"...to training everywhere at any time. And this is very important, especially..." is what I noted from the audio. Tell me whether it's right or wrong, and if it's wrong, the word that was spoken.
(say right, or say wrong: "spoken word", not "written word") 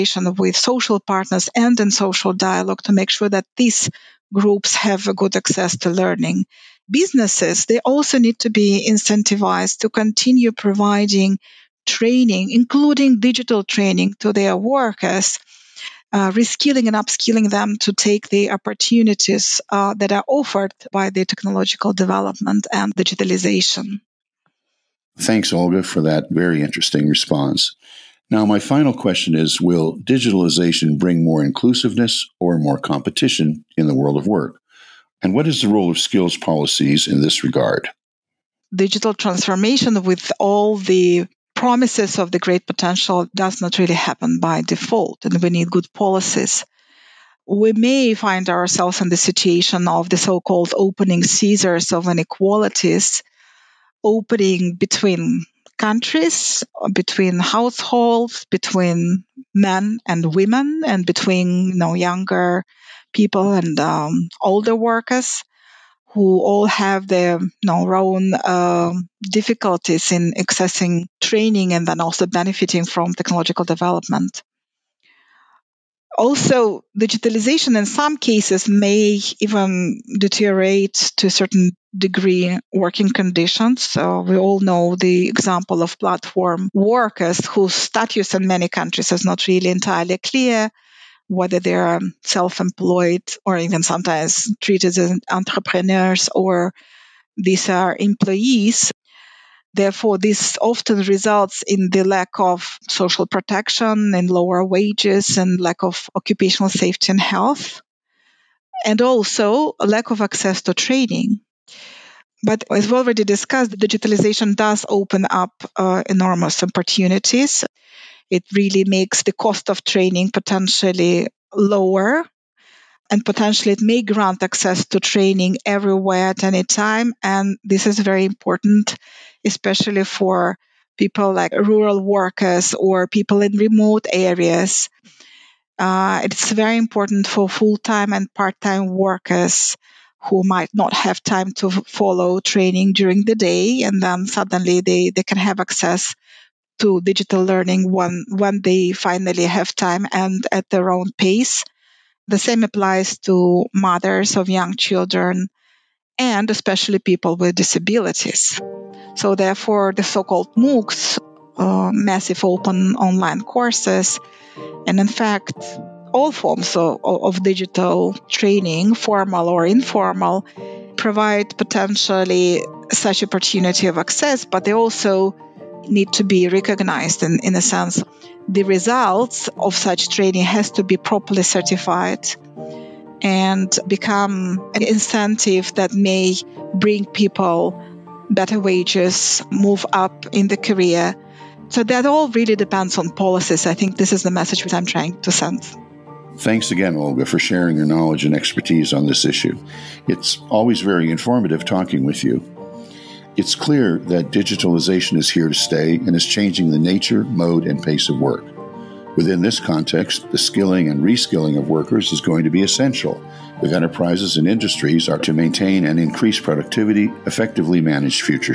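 right.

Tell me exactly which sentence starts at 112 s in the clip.
But as we already discussed, digitalization does open up uh, enormous opportunities.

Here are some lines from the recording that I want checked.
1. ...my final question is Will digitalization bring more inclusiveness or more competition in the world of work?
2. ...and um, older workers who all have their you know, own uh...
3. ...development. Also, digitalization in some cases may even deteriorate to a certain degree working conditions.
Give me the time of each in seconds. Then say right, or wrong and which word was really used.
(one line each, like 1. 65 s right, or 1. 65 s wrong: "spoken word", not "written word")
1. 28 s right
2. 63 s right
3. 73 s right.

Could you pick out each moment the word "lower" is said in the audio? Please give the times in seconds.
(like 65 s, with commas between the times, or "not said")
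104 s, 121 s.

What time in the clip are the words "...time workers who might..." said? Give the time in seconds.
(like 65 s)
138 s.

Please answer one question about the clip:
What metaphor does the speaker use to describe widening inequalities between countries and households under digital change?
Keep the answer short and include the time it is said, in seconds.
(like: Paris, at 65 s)
opening scissors, at 50 s.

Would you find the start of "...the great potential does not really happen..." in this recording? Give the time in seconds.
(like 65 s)
42 s.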